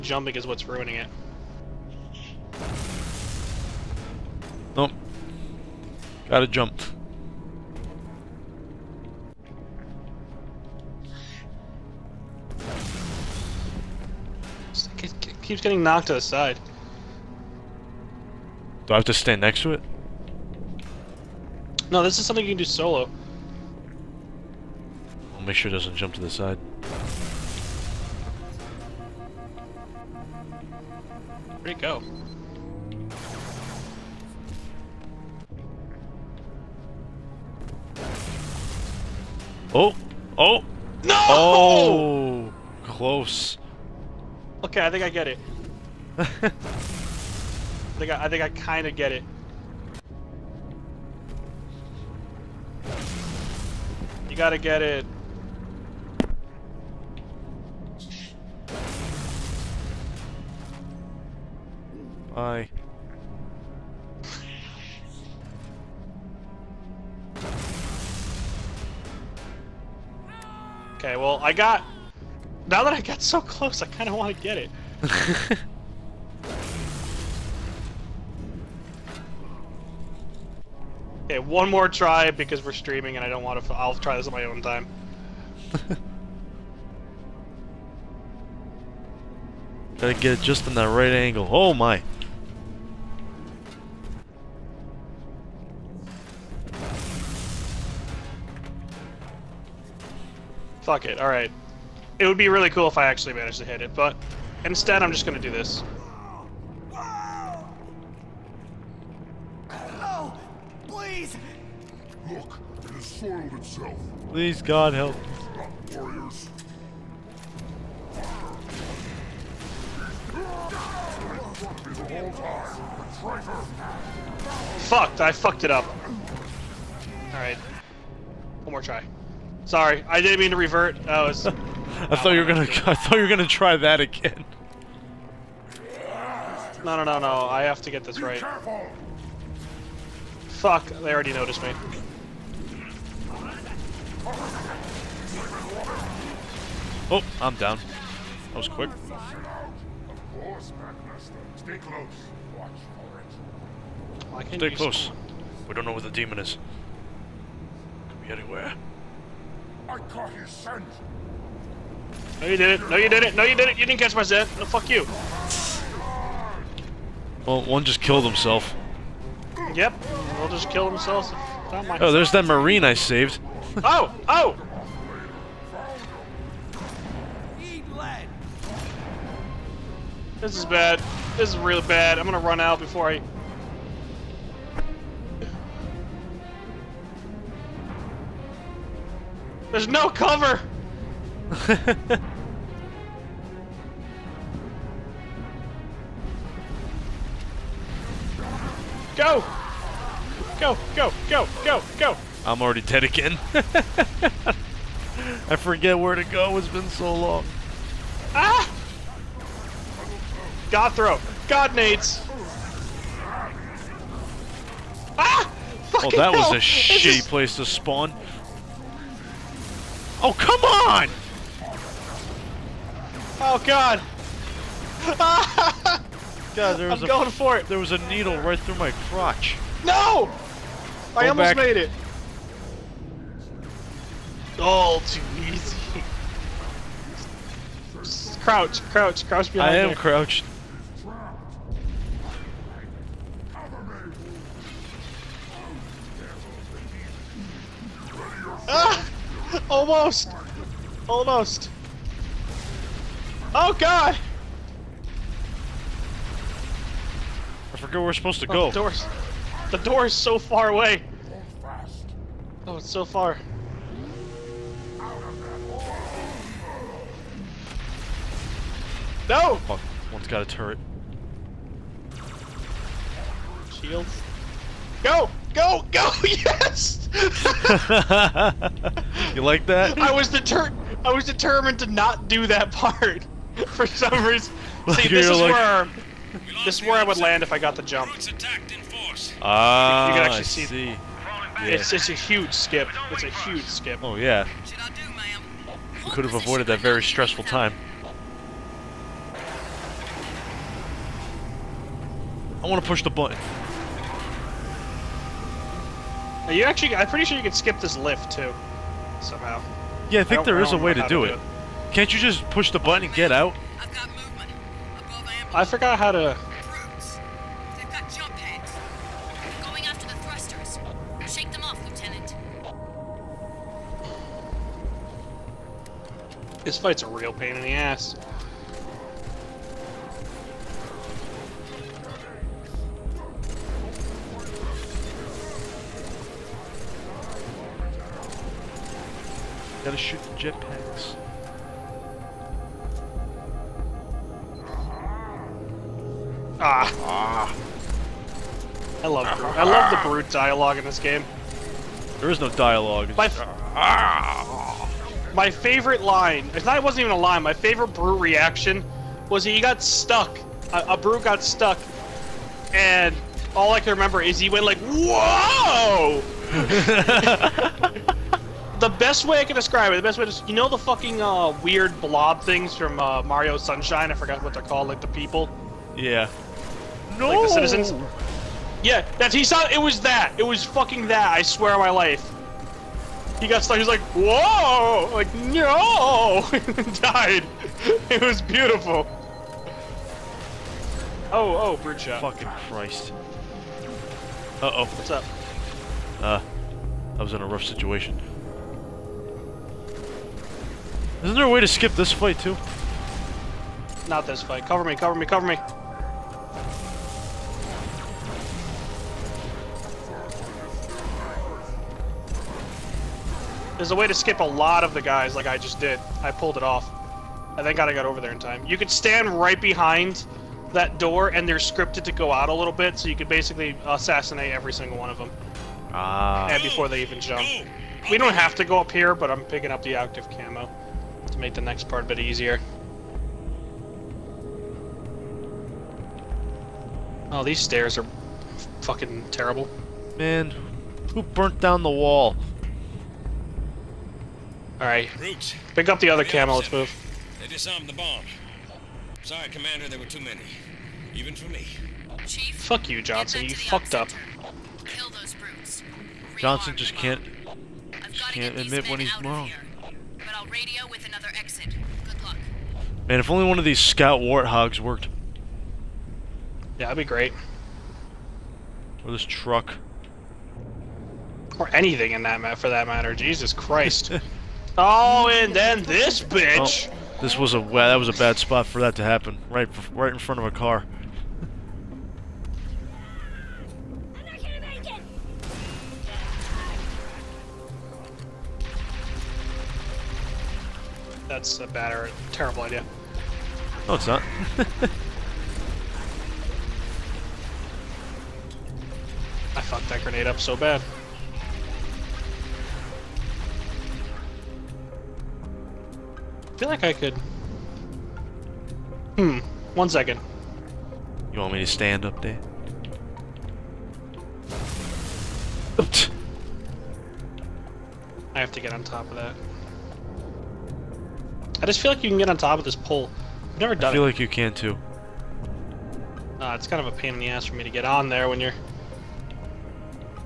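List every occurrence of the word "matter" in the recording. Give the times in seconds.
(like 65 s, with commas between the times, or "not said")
472 s.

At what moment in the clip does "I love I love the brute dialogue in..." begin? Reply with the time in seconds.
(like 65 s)
349 s.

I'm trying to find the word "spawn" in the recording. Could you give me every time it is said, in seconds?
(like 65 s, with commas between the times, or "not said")
217 s.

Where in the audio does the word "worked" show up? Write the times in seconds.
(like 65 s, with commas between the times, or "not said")
464 s.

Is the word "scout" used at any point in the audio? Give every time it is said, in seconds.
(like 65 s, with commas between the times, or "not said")
463 s.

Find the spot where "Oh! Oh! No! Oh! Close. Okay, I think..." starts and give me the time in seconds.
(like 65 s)
39 s.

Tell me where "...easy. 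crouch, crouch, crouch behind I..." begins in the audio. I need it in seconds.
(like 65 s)
235 s.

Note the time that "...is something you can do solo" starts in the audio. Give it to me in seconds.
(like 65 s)
22 s.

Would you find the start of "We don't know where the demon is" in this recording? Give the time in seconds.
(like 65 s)
155 s.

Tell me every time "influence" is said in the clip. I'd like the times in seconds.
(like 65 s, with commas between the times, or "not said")
not said.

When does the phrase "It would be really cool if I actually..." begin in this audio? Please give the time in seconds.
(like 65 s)
102 s.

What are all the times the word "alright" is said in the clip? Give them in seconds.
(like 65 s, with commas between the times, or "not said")
101 s, 127 s, 444 s.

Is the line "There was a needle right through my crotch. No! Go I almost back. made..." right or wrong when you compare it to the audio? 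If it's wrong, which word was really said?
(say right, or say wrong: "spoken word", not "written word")
right.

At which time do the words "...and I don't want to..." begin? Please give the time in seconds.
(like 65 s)
83 s.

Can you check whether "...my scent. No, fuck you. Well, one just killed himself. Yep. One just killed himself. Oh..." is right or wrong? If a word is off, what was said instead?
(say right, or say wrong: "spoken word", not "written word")
right.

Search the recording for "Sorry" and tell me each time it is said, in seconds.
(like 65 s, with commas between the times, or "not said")
129 s, 449 s.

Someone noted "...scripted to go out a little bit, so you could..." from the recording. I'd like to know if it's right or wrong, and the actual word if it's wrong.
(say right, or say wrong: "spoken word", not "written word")
right.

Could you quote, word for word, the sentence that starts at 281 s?
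I was determined to not do that part.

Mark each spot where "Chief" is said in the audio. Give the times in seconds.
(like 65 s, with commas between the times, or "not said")
452 s.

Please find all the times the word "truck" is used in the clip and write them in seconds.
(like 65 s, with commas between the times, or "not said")
469 s.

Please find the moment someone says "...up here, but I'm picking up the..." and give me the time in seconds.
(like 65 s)
428 s.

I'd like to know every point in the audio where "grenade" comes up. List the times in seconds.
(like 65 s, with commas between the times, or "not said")
500 s.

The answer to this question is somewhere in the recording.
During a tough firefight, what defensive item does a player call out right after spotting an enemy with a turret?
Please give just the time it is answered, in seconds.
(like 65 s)
273 s.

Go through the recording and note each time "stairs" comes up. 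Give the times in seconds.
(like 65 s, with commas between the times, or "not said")
437 s.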